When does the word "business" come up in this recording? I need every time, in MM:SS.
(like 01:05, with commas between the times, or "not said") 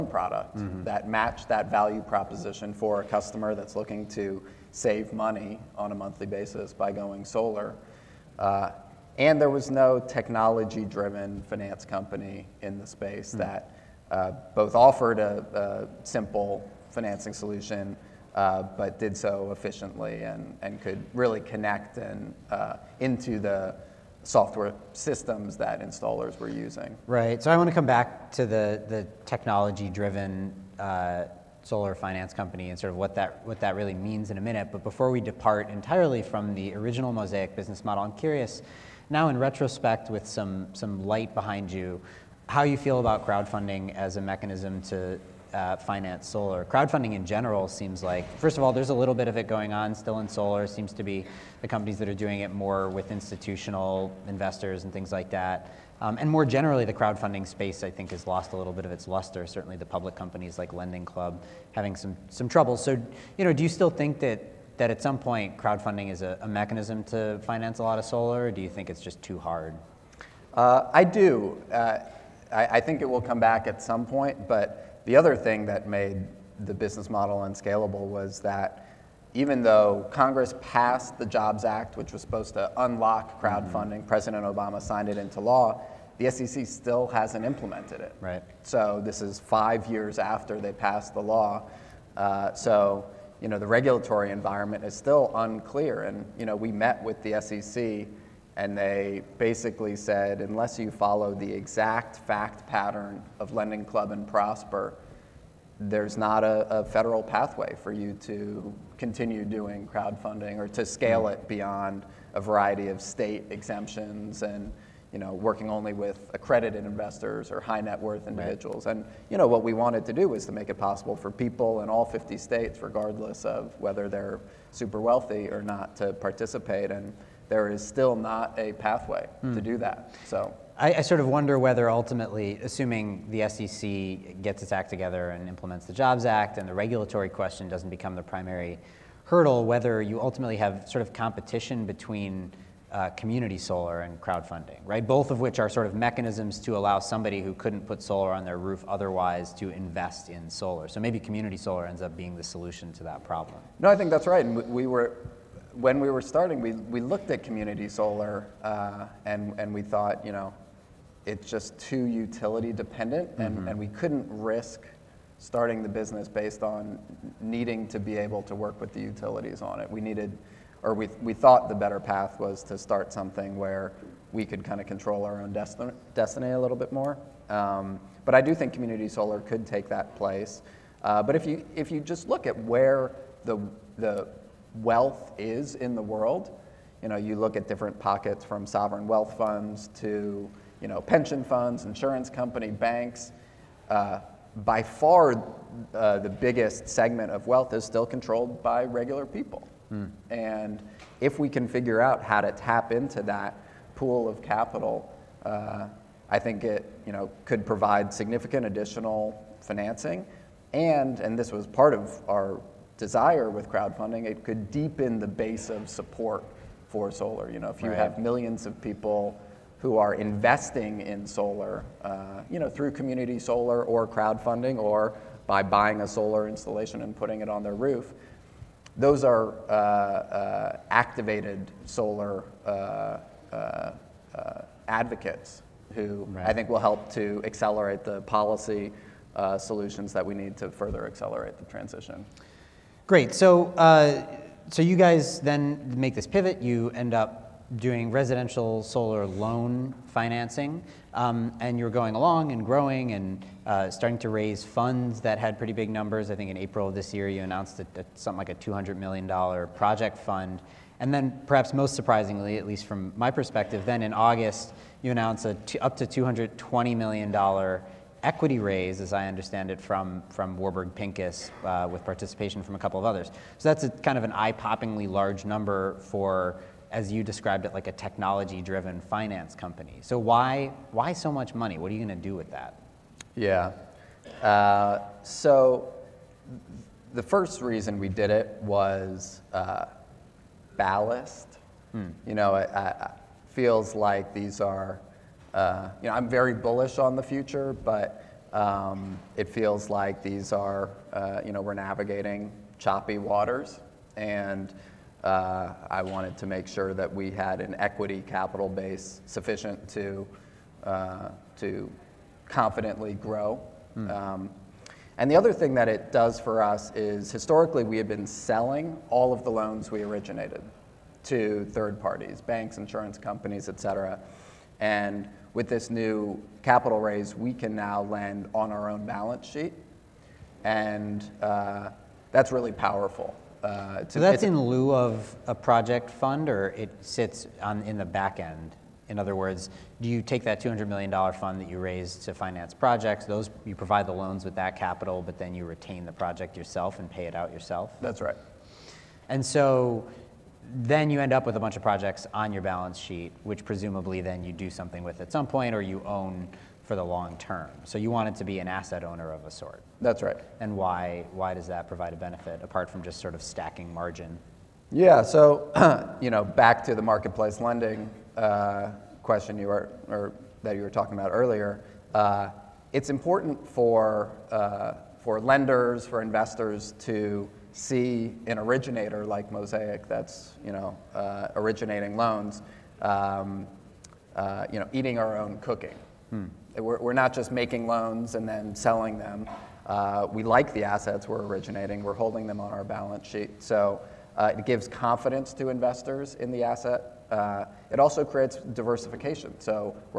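00:37, 01:16, 02:45.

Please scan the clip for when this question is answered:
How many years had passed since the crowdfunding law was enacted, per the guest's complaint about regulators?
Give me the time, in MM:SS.
01:29.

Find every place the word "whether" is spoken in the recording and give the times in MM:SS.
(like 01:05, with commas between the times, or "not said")
02:03, 02:11, 02:19.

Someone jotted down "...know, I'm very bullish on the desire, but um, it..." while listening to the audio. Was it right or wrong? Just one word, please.
wrong.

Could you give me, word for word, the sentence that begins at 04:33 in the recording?
So that's a, kind of an eye-poppingly large number for, as you described it, like a technology-driven finance company.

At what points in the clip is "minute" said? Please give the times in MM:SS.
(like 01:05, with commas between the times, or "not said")
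00:34.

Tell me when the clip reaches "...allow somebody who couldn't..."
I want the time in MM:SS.
02:26.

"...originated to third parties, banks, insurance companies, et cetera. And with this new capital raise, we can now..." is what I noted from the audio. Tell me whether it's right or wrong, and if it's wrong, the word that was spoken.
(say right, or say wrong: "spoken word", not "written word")
right.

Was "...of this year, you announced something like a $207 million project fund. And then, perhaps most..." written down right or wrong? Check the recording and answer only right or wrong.
wrong.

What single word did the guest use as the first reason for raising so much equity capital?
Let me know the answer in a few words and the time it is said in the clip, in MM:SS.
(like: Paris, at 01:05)
ballast, at 04:50.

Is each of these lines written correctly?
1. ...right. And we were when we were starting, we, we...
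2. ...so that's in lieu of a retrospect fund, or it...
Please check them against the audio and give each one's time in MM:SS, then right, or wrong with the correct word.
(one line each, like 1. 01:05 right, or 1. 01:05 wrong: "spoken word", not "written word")
1. 02:34 right
2. 05:34 wrong: "project", not "retrospect".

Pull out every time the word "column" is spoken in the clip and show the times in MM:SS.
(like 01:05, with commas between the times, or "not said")
not said.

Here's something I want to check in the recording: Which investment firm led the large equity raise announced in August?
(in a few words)
Warburg Pincus.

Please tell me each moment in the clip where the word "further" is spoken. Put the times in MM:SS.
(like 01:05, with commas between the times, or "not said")
04:00.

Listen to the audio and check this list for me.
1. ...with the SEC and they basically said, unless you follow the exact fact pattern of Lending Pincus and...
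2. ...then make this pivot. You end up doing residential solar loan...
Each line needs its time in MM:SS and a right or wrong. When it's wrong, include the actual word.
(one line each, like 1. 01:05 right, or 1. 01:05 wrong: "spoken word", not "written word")
1. 01:37 wrong: "Club", not "Pincus"
2. 04:05 right.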